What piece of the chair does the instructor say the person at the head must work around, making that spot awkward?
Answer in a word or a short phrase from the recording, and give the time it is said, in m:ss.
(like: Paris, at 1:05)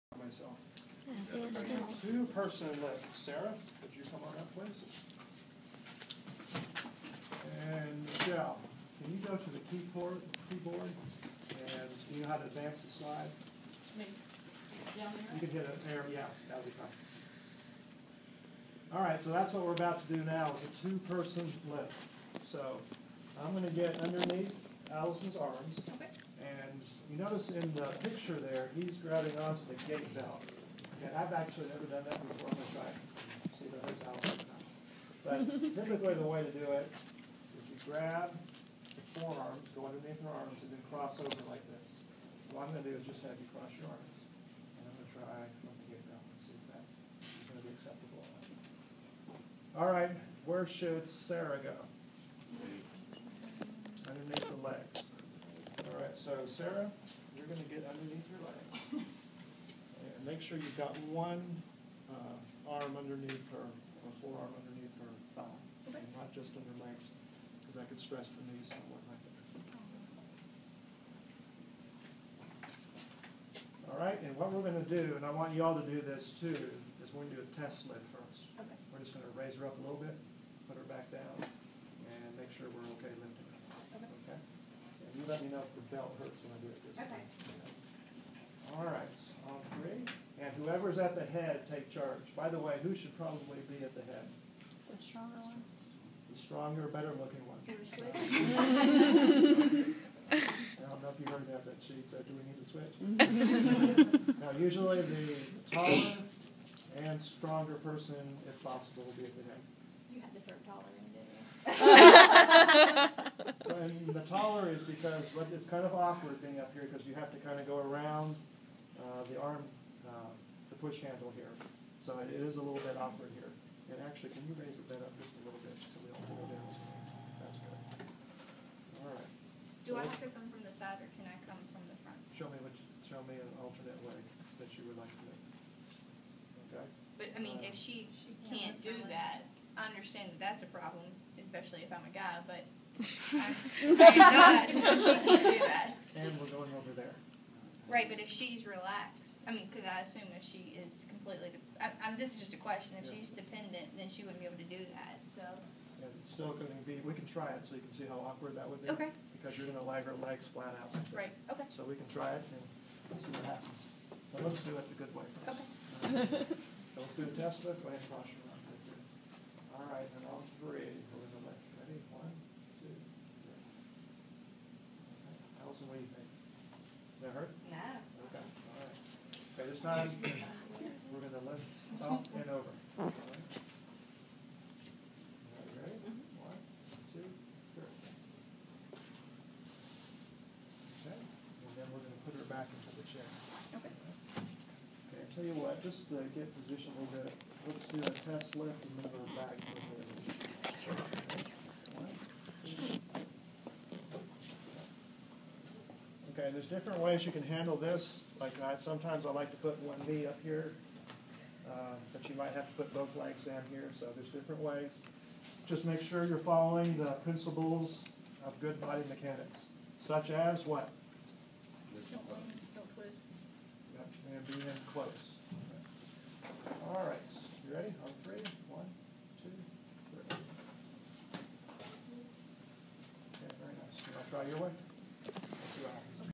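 Push handle, at 2:00.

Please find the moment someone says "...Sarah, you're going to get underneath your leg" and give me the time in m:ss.
0:56.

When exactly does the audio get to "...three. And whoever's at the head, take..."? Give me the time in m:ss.
1:29.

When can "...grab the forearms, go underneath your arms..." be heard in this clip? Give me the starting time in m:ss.
0:37.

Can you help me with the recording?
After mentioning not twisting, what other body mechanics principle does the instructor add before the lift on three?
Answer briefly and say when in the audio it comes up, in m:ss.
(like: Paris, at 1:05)
Be in close, at 3:44.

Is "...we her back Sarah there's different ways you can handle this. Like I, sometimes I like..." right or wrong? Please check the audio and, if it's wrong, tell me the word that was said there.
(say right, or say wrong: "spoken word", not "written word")
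wrong: "And", not "Sarah".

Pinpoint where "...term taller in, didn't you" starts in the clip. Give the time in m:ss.
1:50.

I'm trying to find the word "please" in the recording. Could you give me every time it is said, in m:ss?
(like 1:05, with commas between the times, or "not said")
0:04.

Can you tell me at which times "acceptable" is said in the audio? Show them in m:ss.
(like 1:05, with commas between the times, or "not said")
0:47.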